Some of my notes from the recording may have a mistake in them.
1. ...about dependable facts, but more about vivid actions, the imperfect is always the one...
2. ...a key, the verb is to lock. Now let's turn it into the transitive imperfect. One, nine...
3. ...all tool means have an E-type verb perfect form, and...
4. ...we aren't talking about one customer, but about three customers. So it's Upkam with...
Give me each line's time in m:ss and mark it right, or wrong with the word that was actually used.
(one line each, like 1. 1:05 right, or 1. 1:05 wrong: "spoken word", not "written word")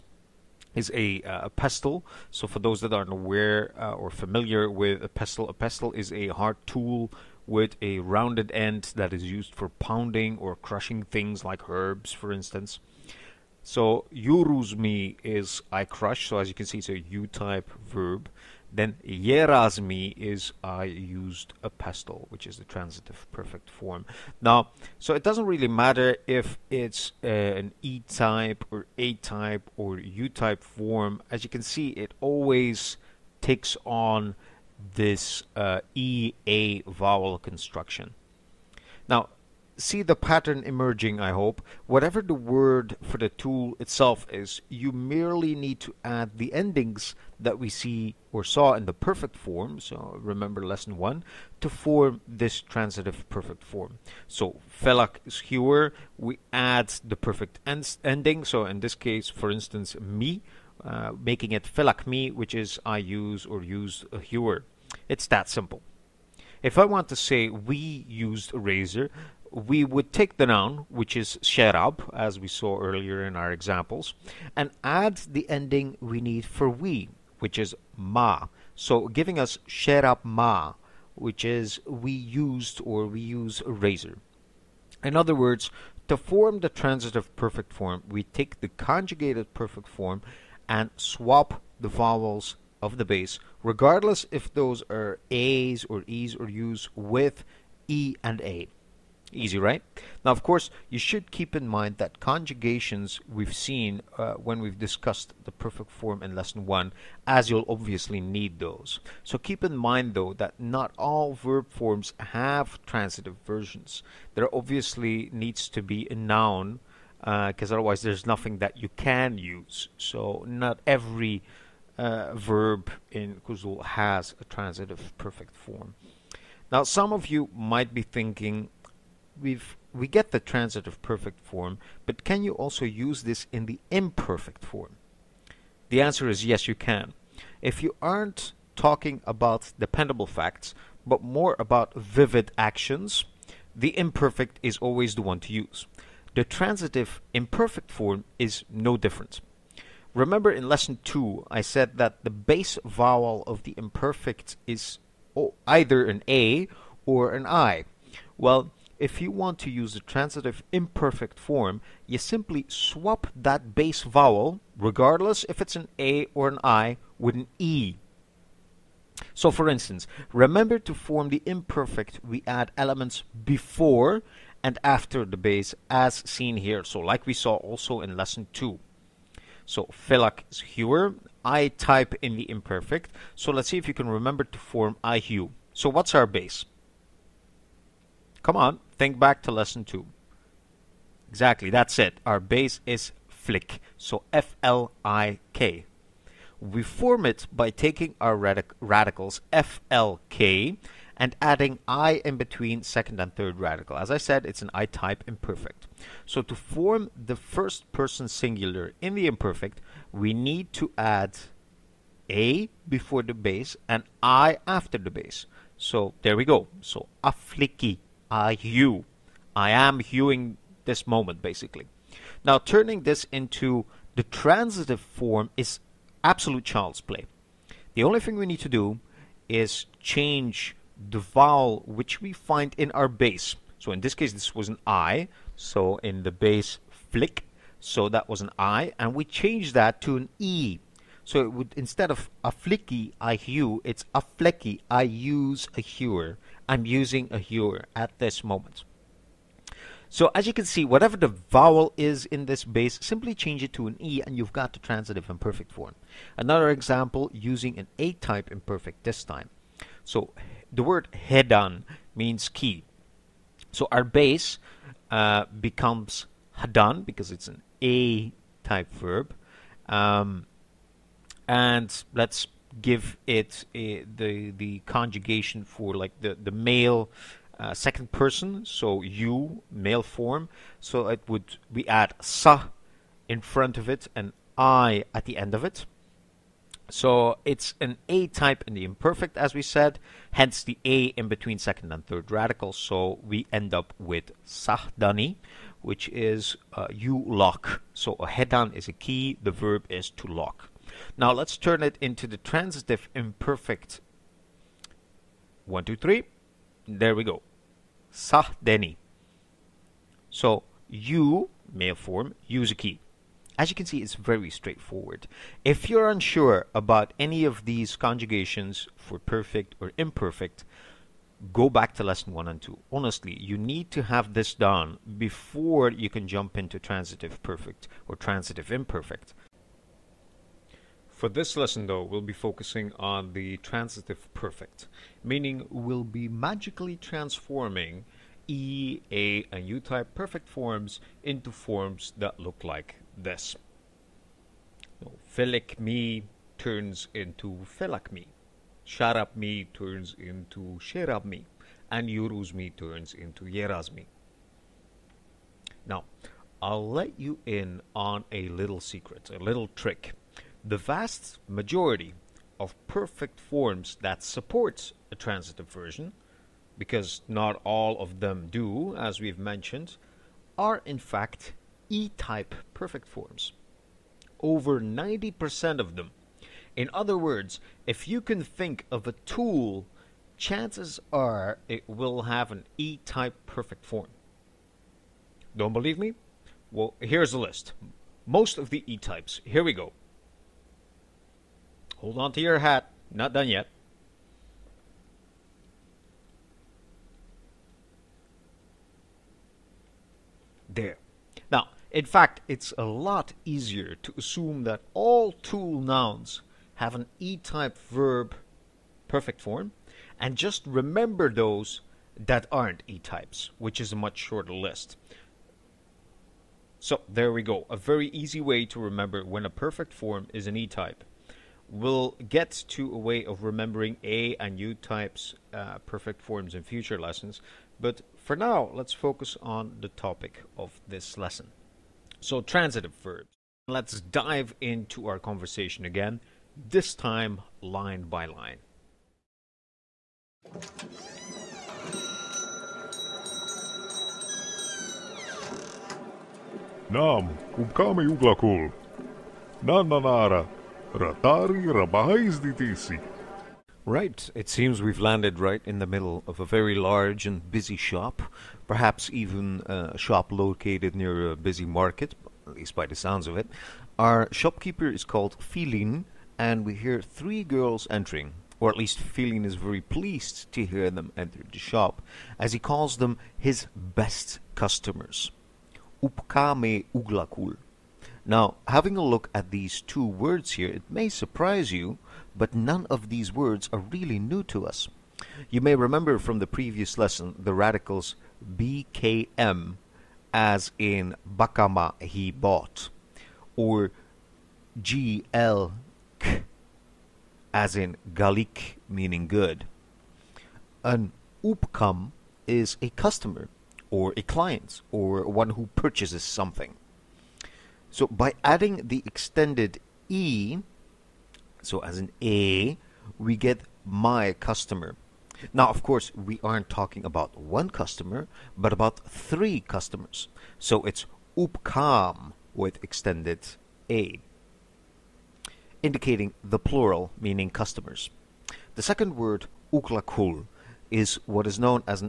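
1. 2:19 right
2. 4:58 wrong: "two", not "nine"
3. 6:44 wrong: "nouns", not "means"
4. 8:36 right.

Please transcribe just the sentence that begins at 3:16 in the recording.
We form it by taking our radic- radicals F L K and adding i in between second and third radical.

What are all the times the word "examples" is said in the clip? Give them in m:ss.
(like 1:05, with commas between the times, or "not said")
1:13, 4:16.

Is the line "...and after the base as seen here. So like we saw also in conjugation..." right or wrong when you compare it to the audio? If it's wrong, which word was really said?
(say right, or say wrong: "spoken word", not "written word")
wrong: "lesson", not "conjugation".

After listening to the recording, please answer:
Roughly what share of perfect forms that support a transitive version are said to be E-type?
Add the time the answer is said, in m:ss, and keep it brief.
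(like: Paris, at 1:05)
Over 90%, at 6:14.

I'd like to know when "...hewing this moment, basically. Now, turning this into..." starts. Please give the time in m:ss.
3:40.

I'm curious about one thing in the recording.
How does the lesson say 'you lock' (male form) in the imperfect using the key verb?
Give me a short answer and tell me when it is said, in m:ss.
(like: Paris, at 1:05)
sahdani, at 4:54.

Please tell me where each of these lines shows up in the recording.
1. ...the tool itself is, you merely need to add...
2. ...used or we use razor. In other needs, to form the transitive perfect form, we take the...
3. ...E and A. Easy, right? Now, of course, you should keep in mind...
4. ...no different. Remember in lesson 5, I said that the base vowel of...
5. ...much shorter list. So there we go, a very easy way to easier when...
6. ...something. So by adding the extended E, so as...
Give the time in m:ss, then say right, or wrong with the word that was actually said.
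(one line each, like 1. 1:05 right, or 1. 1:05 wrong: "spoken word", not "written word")
1. 0:43 right
2. 1:22 wrong: "words", not "needs"
3. 1:37 right
4. 2:28 wrong: "2", not "5"
5. 6:53 wrong: "remember", not "easier"
6. 8:26 right.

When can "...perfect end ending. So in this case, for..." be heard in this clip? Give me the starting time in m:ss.
0:57.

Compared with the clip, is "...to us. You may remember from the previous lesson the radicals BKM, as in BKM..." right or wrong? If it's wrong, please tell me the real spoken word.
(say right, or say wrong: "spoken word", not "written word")
wrong: "Bakama", not "BKM".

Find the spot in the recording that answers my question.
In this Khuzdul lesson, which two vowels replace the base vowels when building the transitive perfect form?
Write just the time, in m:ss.
0:35.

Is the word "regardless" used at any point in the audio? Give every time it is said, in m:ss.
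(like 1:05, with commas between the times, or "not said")
1:33, 2:44.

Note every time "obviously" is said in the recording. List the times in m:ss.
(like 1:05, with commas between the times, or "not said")
1:47, 1:54.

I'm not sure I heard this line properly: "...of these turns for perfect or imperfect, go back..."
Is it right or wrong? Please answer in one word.
wrong.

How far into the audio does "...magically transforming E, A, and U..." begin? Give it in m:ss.
5:36.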